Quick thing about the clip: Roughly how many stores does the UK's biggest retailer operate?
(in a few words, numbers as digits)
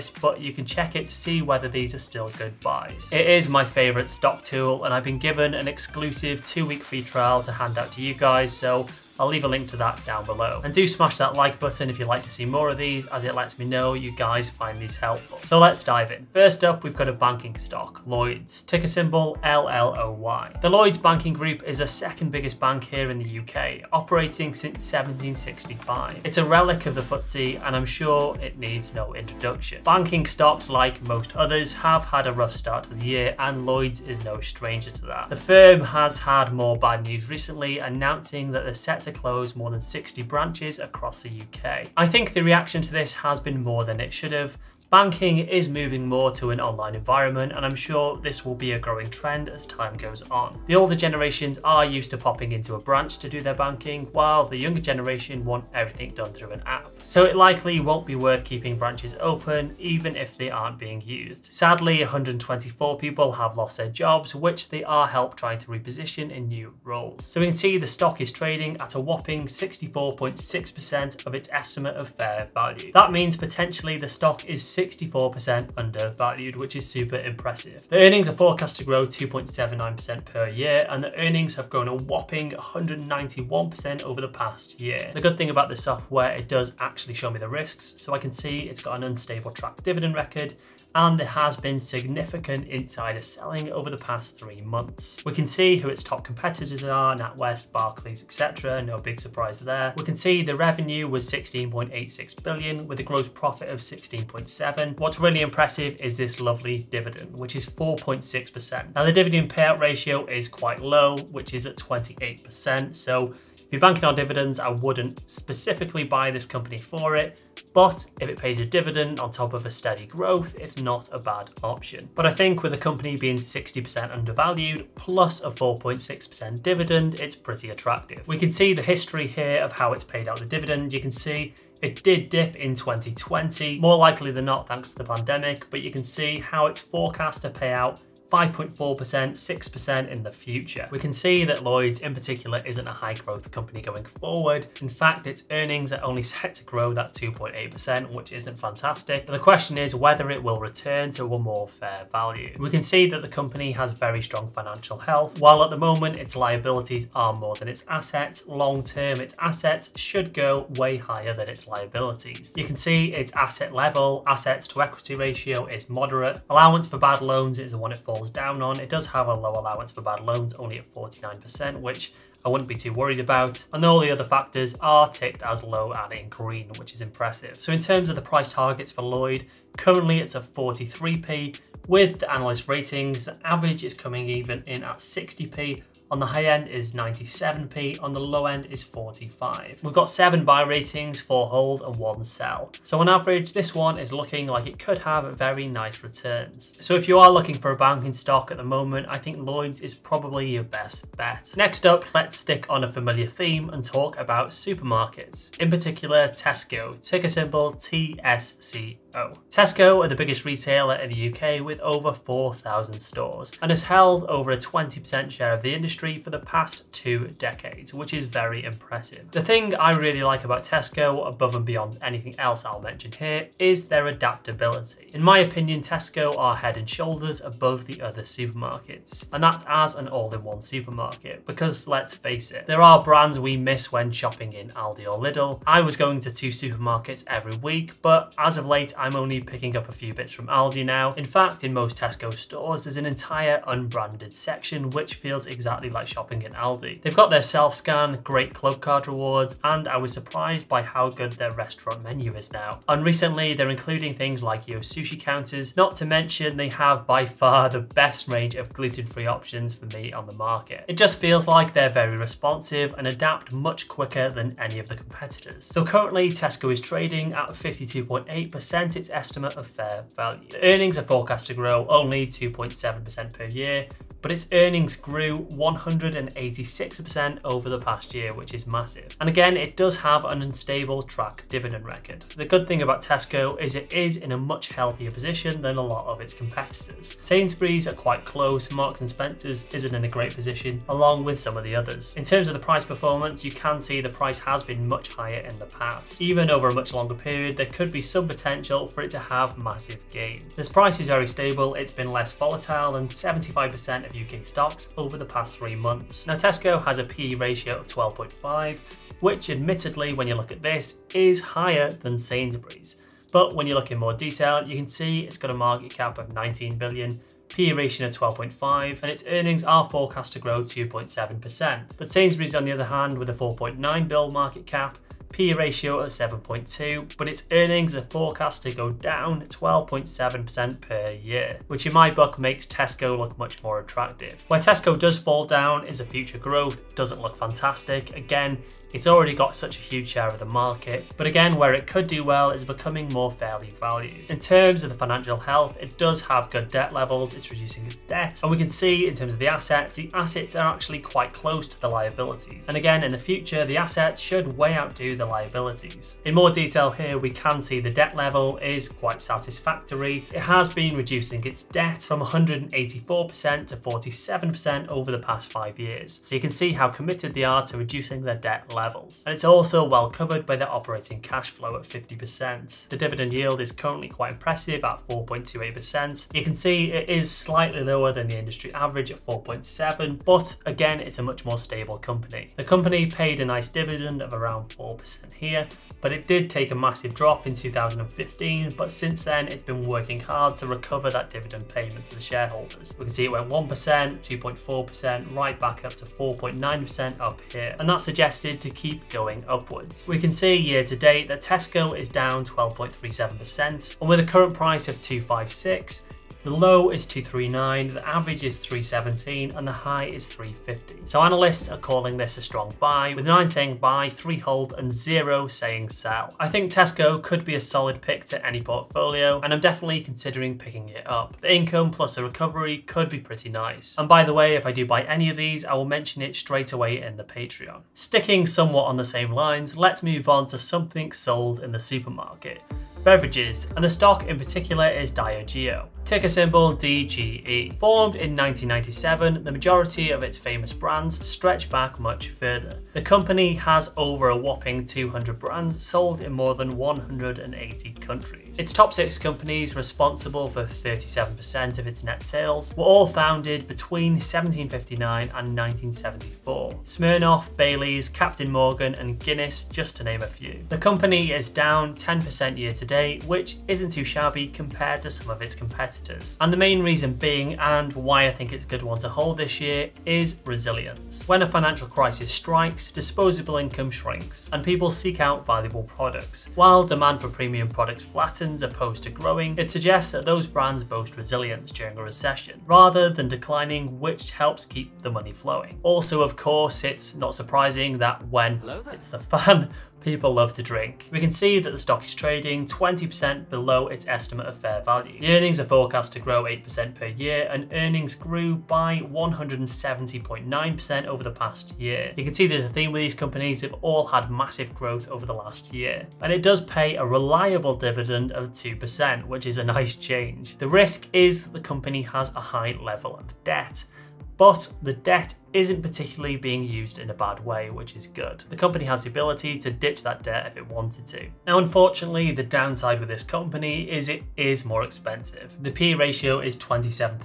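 over 4,000.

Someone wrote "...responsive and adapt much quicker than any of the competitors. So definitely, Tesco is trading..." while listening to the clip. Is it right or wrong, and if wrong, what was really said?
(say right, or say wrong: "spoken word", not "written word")
wrong: "currently", not "definitely".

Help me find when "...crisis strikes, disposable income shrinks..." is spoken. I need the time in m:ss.
7:51.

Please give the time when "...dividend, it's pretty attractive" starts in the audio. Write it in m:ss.
2:06.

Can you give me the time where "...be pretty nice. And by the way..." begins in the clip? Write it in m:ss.
7:03.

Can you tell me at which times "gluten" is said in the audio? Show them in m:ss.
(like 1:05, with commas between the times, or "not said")
4:18.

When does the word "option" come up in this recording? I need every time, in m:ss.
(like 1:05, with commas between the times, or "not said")
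2:01, 4:19.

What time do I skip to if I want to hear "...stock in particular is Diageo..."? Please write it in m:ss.
7:13.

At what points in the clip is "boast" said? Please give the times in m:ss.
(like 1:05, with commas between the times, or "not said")
8:00.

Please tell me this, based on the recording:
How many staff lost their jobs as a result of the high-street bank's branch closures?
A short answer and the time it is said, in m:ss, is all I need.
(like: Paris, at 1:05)
124, at 1:02.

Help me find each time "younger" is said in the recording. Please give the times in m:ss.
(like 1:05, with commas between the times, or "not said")
0:54.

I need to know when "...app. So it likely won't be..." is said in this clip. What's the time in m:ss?
0:56.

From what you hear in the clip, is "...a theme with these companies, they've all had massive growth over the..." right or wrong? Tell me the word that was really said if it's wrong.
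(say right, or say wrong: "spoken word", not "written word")
right.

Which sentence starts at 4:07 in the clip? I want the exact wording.
They've got their self-scan, great club card rewards, and I was surprised by how good their restaurant menu is now.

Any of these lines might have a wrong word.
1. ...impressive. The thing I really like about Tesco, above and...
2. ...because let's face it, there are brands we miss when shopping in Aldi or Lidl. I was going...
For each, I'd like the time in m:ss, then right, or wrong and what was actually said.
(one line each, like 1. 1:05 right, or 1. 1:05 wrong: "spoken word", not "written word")
1. 3:38 right
2. 3:51 right.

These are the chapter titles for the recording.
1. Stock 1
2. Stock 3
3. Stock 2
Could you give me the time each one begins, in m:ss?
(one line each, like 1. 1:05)
1. 0:14
2. 6:59
3. 3:14.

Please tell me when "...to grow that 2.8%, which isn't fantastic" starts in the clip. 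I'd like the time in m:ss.
2:26.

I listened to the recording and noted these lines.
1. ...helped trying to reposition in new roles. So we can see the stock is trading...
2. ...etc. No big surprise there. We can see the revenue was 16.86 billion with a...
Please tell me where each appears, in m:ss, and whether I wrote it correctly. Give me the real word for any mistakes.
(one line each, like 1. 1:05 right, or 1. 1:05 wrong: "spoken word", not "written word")
1. 1:05 right
2. 1:38 right.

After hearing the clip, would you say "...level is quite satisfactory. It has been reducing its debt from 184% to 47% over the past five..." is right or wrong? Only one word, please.
right.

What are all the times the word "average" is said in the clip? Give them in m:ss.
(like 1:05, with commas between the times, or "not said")
3:03, 3:13, 6:18, 6:48.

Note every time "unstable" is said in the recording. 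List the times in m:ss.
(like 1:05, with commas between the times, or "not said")
1:29, 4:40.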